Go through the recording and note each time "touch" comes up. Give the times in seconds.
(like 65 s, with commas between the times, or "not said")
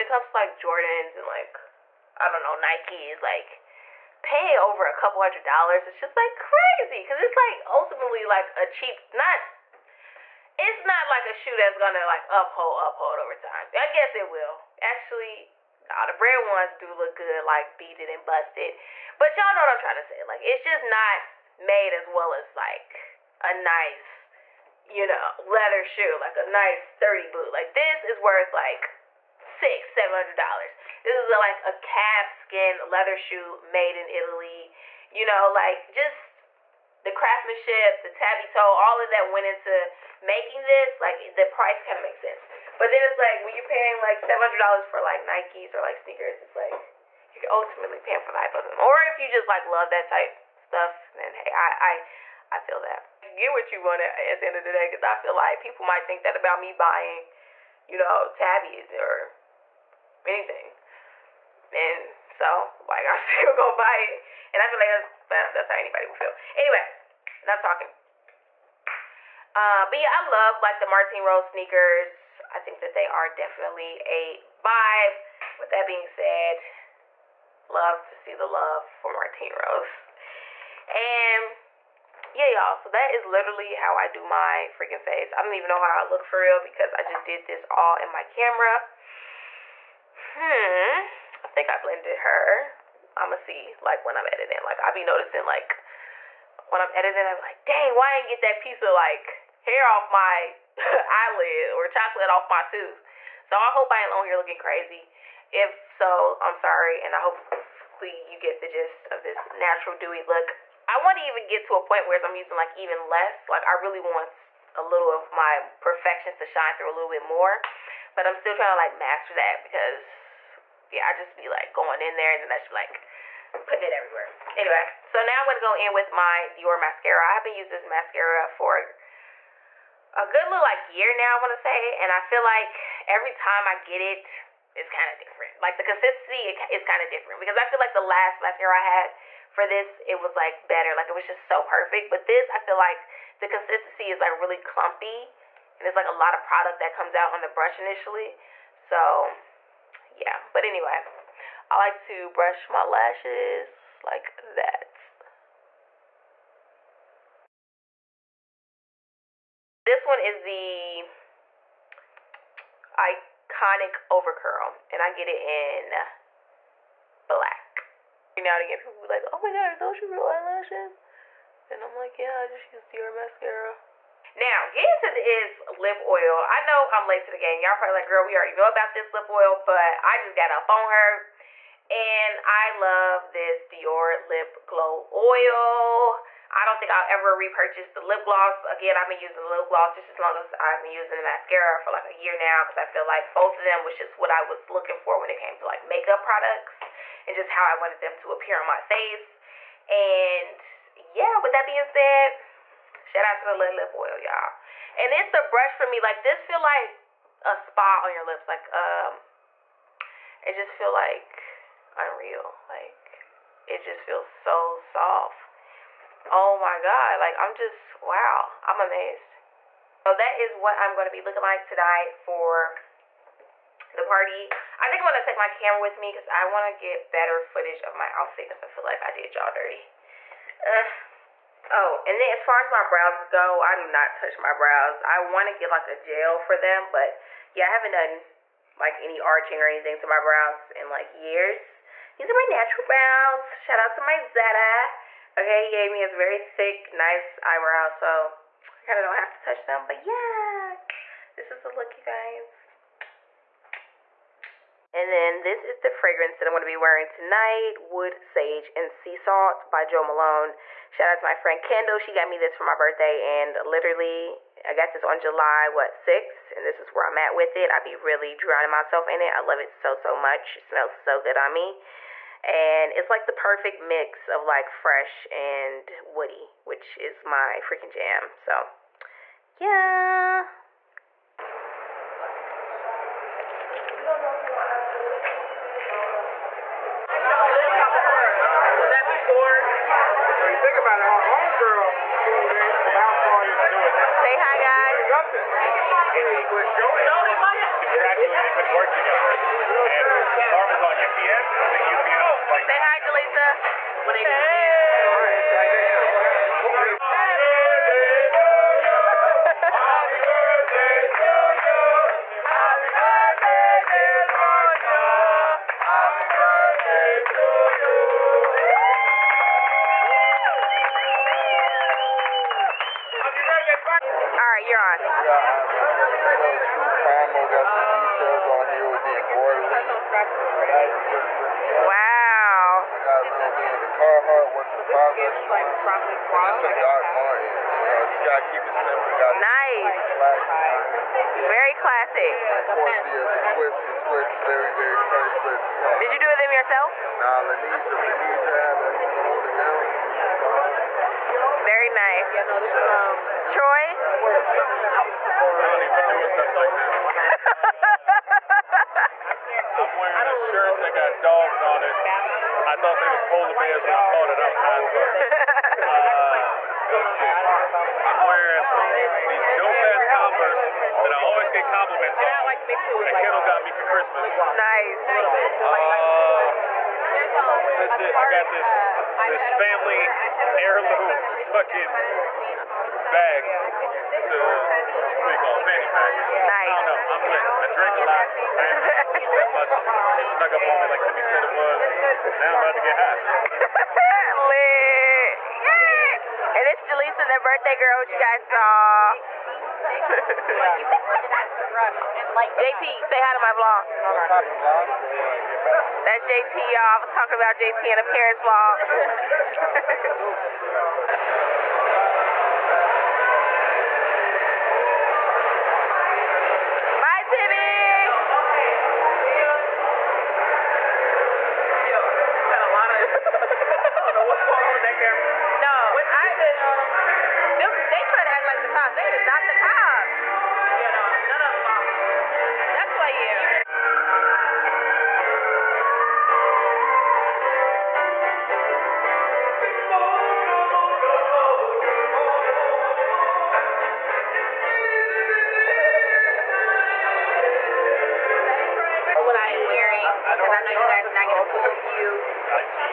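234 s, 249 s.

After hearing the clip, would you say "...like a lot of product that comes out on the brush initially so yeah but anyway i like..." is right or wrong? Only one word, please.
right.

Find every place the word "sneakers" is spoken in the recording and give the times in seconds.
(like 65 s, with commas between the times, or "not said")
45 s, 71 s.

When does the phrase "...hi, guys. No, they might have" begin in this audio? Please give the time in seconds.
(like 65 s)
294 s.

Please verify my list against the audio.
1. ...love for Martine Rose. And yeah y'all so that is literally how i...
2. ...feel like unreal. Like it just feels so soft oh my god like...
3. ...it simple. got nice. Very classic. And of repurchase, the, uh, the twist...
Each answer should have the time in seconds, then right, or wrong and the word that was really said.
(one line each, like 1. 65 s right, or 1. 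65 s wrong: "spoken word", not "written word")
1. 78 s right
2. 210 s right
3. 338 s wrong: "course", not "repurchase".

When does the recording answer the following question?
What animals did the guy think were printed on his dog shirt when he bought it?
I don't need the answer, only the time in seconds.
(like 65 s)
363 s.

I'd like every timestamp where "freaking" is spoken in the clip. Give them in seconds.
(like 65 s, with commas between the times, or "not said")
84 s, 277 s.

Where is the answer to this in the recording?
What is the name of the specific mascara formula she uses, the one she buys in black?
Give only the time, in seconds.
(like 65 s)
162 s.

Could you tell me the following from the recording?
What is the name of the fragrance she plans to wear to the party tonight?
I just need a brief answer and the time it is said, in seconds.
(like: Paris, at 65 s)
Wood Sage and Sea Salt, at 257 s.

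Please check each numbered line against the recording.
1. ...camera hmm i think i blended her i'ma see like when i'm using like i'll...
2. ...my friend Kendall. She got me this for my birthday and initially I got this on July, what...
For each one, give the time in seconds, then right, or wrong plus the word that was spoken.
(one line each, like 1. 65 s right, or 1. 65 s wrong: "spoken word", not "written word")
1. 88 s wrong: "editing", not "using"
2. 261 s wrong: "literally", not "initially".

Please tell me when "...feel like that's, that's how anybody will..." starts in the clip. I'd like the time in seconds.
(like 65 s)
64 s.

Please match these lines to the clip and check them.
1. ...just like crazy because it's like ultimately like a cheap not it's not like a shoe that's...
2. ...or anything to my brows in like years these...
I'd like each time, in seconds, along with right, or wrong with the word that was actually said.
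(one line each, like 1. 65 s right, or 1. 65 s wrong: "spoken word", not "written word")
1. 5 s right
2. 239 s right.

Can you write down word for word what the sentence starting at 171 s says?
And I'm like, yeah, I just used your mascara.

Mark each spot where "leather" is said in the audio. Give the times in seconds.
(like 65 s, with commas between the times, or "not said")
25 s, 32 s.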